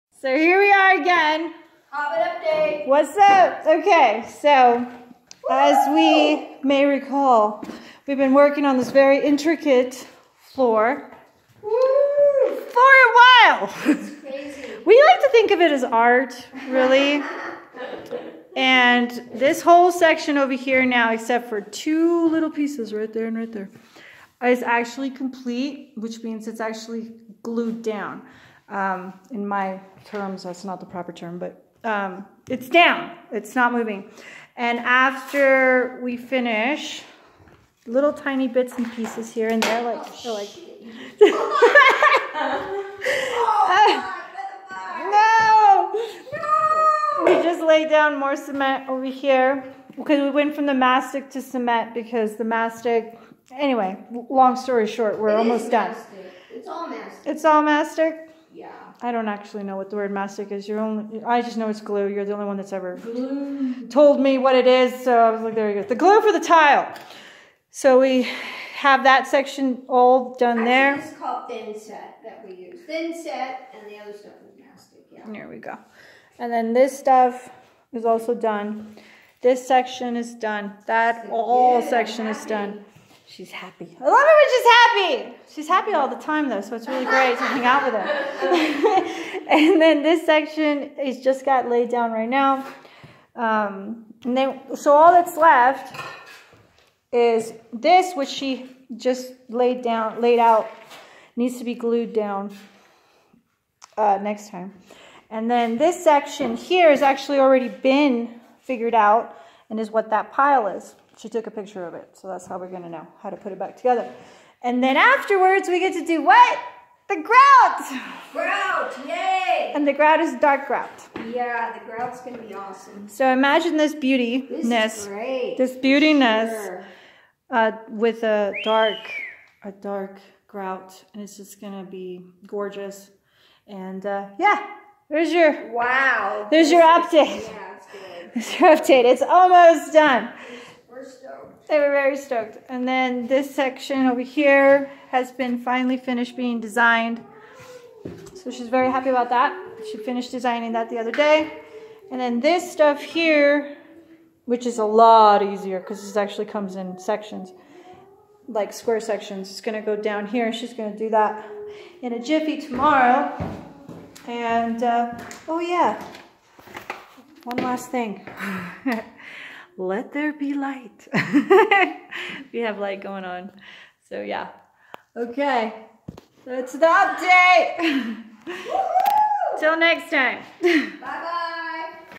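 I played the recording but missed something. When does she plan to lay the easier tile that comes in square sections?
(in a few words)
Tomorrow.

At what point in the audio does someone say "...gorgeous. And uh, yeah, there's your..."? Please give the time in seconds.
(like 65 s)
132 s.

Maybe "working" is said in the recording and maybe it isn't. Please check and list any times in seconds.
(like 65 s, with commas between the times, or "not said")
8 s.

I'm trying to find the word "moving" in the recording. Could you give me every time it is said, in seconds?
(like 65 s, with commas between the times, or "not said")
33 s.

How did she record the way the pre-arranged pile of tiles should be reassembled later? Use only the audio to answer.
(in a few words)
Took a picture.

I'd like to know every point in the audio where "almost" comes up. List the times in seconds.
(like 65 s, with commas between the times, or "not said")
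55 s, 139 s.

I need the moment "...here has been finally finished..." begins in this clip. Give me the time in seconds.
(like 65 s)
144 s.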